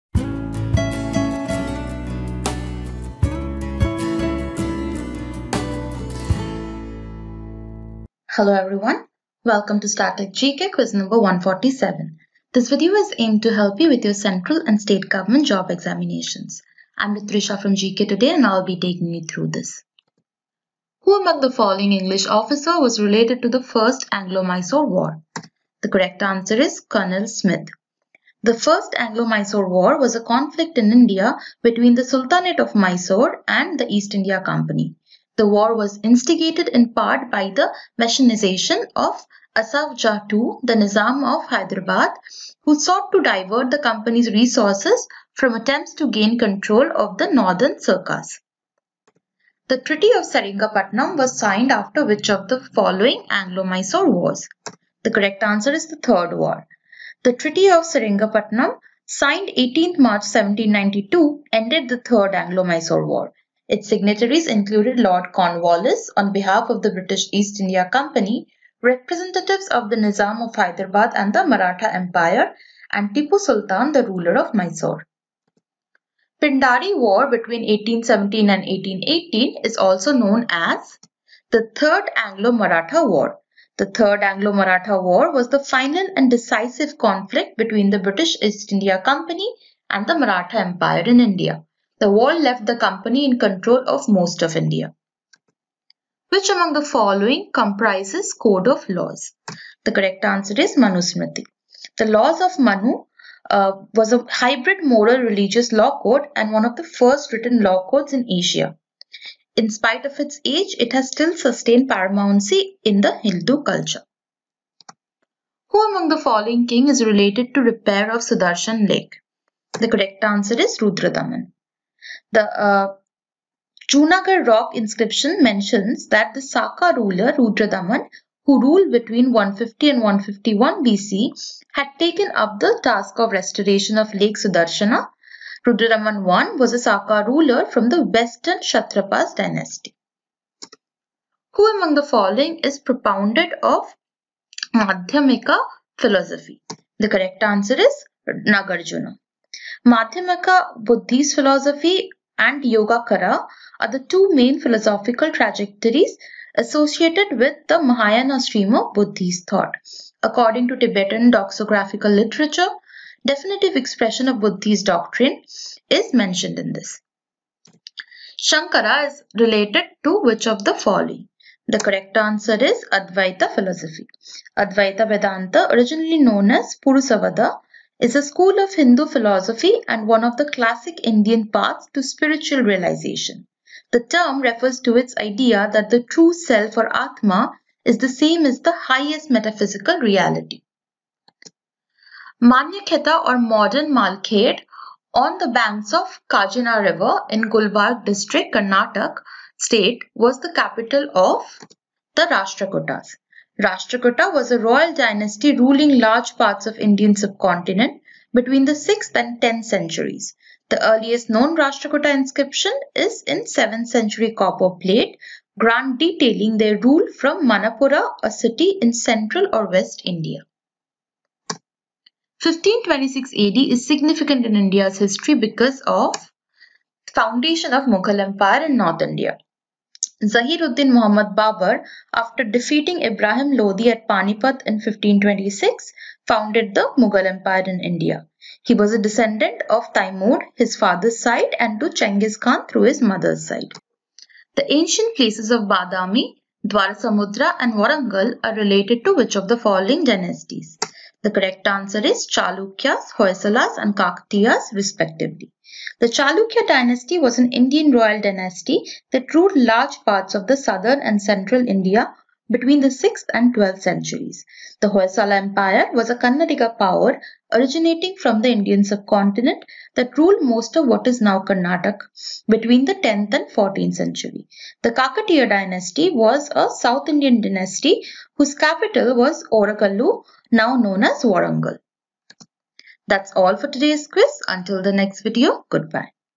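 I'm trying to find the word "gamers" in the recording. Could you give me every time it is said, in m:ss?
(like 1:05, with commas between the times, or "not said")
not said.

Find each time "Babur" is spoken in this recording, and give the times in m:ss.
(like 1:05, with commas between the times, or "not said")
3:51.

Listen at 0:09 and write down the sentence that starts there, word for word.
Welcome to Static GK quiz number 147.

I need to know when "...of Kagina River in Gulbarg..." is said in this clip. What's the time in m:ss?
3:15.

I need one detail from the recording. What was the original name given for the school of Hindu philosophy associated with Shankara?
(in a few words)
Purusavada.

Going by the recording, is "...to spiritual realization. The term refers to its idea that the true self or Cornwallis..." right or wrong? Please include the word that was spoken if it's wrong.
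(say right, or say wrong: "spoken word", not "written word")
wrong: "Atma", not "Cornwallis".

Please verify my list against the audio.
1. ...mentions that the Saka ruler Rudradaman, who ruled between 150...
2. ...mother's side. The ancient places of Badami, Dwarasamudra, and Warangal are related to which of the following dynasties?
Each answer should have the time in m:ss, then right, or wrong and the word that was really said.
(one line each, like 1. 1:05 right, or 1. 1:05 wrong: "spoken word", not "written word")
1. 2:05 right
2. 4:03 right.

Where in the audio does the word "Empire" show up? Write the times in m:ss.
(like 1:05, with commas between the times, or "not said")
1:11, 1:30, 3:48, 3:57, 4:25.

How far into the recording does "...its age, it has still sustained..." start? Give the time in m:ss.
1:50.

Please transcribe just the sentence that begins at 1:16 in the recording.
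Pindari War between 1817 and 1818 is also known as the Third Anglo-Maratha War.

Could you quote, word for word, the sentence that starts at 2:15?
Rudradaman I was a Saka ruler from the western Kshatrapas dynasty.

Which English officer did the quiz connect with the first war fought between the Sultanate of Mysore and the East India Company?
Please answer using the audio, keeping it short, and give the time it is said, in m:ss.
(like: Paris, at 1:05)
Colonel Smith, at 0:26.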